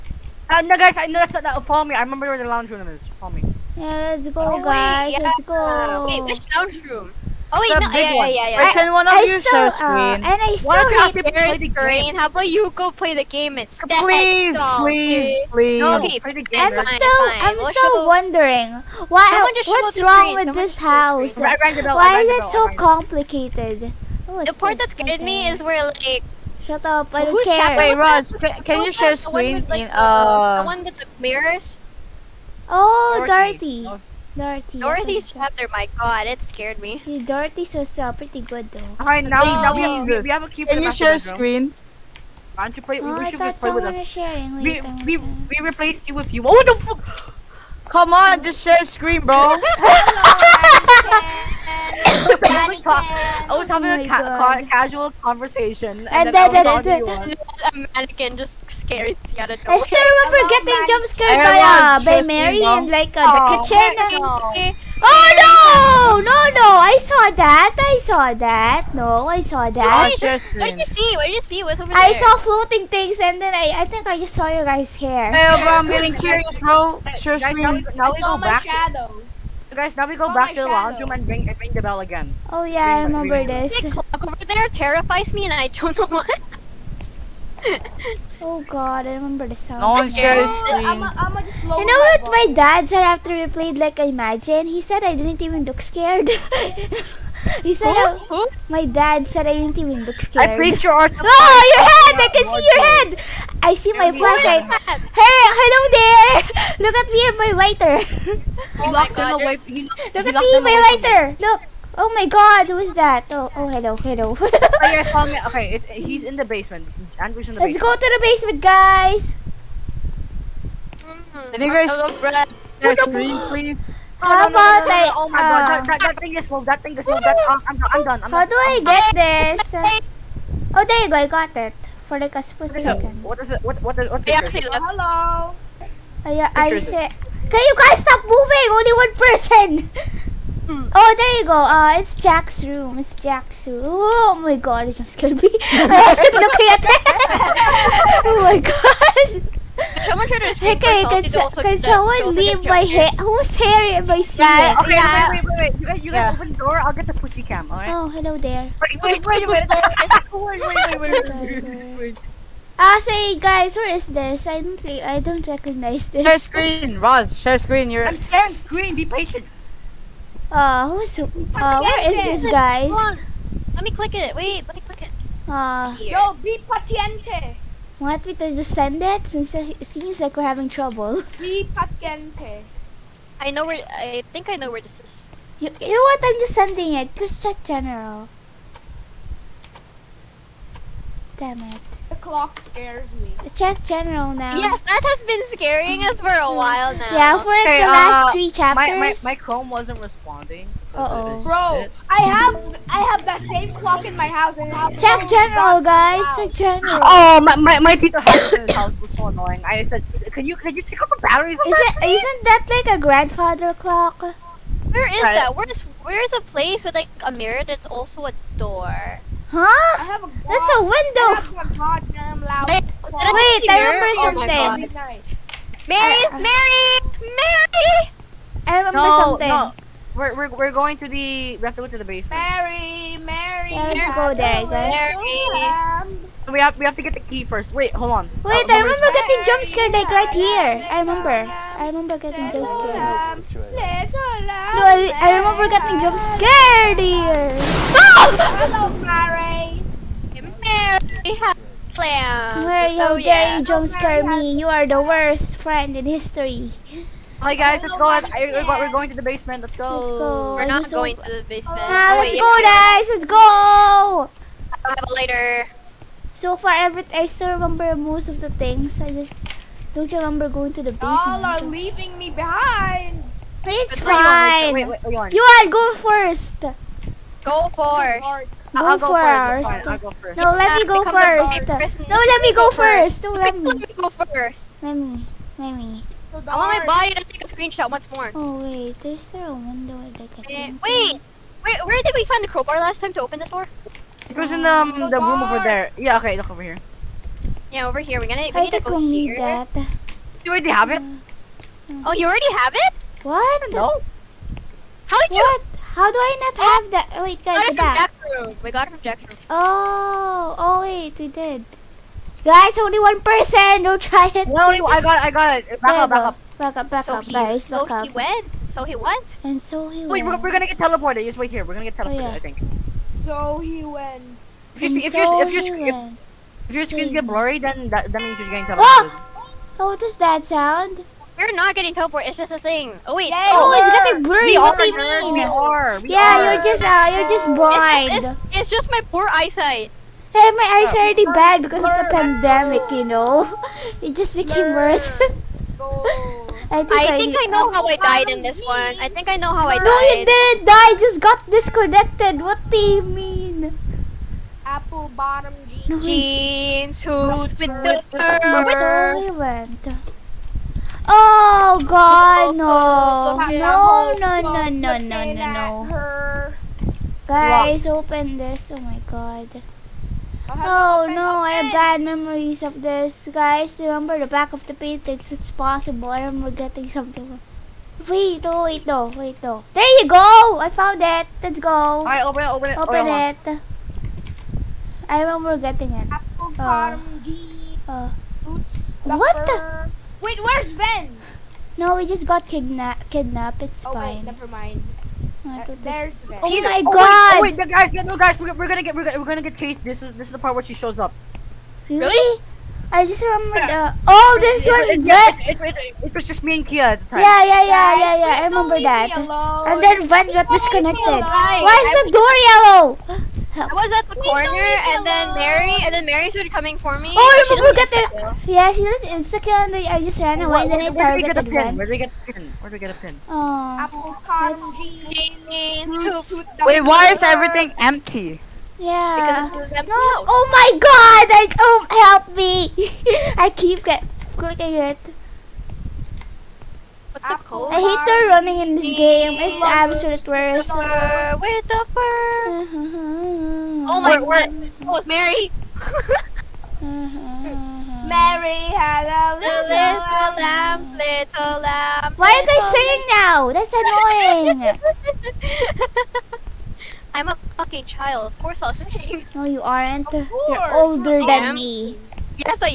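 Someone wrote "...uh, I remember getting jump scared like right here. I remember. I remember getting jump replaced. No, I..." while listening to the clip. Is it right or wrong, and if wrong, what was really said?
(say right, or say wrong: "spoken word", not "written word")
wrong: "scared", not "replaced".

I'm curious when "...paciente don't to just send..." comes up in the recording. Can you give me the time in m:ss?
2:56.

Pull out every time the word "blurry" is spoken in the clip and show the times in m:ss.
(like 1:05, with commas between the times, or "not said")
5:27, 5:34.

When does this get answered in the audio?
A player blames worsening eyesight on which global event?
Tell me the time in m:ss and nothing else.
5:42.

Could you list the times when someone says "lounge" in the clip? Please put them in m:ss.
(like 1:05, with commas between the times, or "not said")
0:02, 0:06, 1:20.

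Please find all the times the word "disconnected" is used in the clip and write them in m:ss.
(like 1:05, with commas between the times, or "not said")
5:51, 6:50.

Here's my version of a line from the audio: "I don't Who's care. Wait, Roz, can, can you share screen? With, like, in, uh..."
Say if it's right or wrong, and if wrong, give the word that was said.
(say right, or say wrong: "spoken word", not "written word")
right.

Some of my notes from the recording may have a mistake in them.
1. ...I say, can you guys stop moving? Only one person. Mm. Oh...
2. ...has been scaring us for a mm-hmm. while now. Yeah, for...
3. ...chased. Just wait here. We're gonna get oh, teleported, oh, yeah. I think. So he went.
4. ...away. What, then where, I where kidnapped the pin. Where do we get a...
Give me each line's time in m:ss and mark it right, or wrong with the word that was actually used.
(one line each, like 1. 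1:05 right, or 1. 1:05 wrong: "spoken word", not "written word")
1. 2:16 right
2. 3:15 right
3. 5:20 wrong: "teleported", not "chased"
4. 7:00 wrong: "targeted", not "kidnapped".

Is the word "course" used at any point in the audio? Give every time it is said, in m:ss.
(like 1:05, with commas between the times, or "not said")
7:38.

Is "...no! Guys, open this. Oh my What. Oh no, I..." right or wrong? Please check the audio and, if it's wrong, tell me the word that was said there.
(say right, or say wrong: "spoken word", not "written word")
wrong: "God", not "What".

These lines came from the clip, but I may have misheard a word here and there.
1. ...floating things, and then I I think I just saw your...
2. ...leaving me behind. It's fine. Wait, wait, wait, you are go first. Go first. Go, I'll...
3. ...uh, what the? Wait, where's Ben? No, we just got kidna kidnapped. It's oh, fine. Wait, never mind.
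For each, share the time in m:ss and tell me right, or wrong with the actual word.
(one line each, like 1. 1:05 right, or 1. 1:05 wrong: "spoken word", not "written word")
1. 1:12 right
2. 4:31 right
3. 6:27 right.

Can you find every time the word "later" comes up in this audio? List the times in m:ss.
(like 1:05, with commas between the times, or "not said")
4:25.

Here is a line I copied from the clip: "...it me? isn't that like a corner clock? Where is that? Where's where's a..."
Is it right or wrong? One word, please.
wrong.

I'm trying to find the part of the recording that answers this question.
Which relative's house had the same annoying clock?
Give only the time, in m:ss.
3:27.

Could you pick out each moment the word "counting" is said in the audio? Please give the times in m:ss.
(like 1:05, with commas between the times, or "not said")
not said.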